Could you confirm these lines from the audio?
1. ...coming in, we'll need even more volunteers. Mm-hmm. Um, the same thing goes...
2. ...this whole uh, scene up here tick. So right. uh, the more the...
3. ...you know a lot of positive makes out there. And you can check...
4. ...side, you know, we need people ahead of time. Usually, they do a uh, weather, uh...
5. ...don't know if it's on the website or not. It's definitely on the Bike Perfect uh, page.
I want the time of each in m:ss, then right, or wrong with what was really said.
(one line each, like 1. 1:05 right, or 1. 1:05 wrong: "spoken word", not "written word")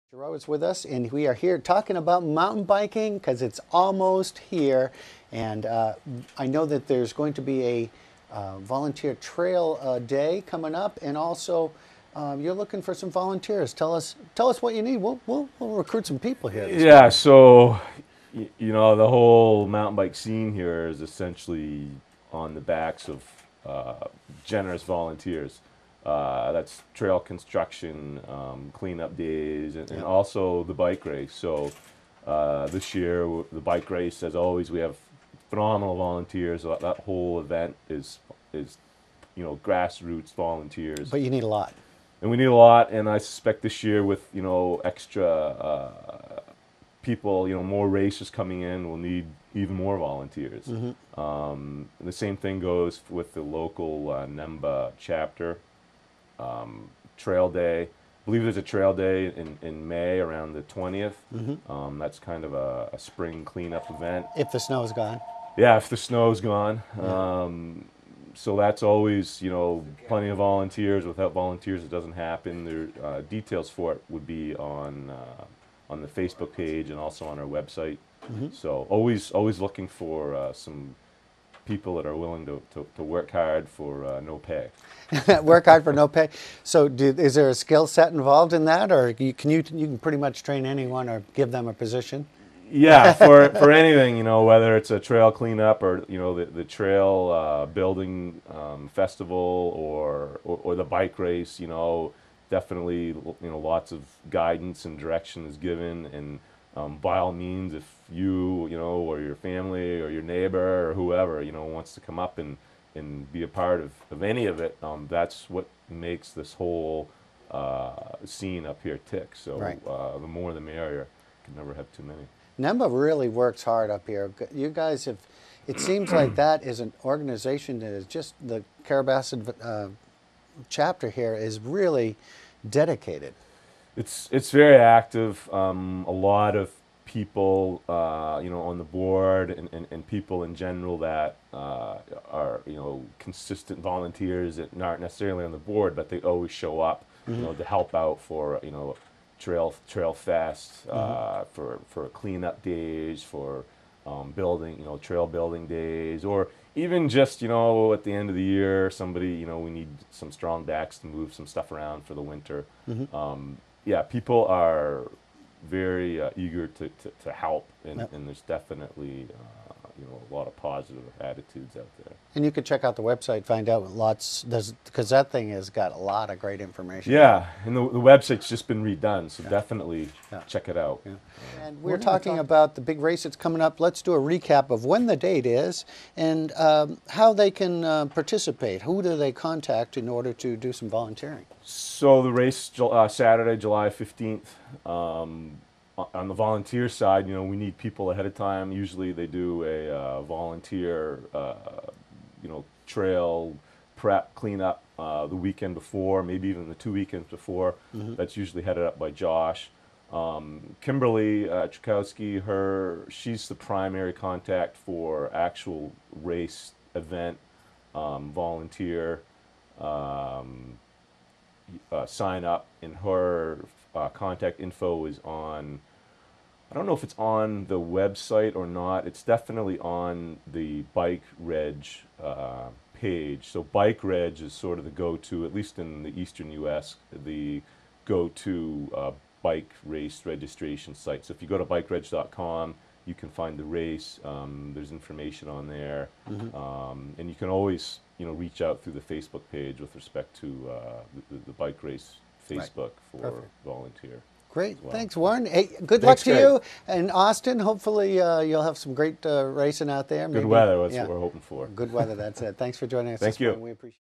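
1. 0:48 right
2. 1:56 right
3. 2:50 wrong: "attitudes", not "makes"
4. 3:16 wrong: "volunteer", not "weather"
5. 3:46 wrong: "Reg", not "Perfect".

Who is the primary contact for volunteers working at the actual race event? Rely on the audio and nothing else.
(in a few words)
Kimberly.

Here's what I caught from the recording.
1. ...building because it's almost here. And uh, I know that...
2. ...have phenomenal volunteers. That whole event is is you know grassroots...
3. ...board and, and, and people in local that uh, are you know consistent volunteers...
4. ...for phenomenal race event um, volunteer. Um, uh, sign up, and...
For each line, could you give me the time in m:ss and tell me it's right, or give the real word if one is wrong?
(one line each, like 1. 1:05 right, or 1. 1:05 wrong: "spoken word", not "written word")
1. 0:02 wrong: "biking", not "building"
2. 0:34 right
3. 2:18 wrong: "general", not "local"
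4. 3:34 wrong: "actual", not "phenomenal".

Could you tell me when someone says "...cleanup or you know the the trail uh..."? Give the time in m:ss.
1:35.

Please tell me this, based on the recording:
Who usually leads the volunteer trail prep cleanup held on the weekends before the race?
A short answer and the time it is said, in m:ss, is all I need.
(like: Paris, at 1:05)
Josh, at 3:29.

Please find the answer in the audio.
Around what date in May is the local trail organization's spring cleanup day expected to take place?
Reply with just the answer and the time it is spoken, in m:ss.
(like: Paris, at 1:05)
the 20th, at 1:00.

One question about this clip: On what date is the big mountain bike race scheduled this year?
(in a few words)
Saturday, July 15.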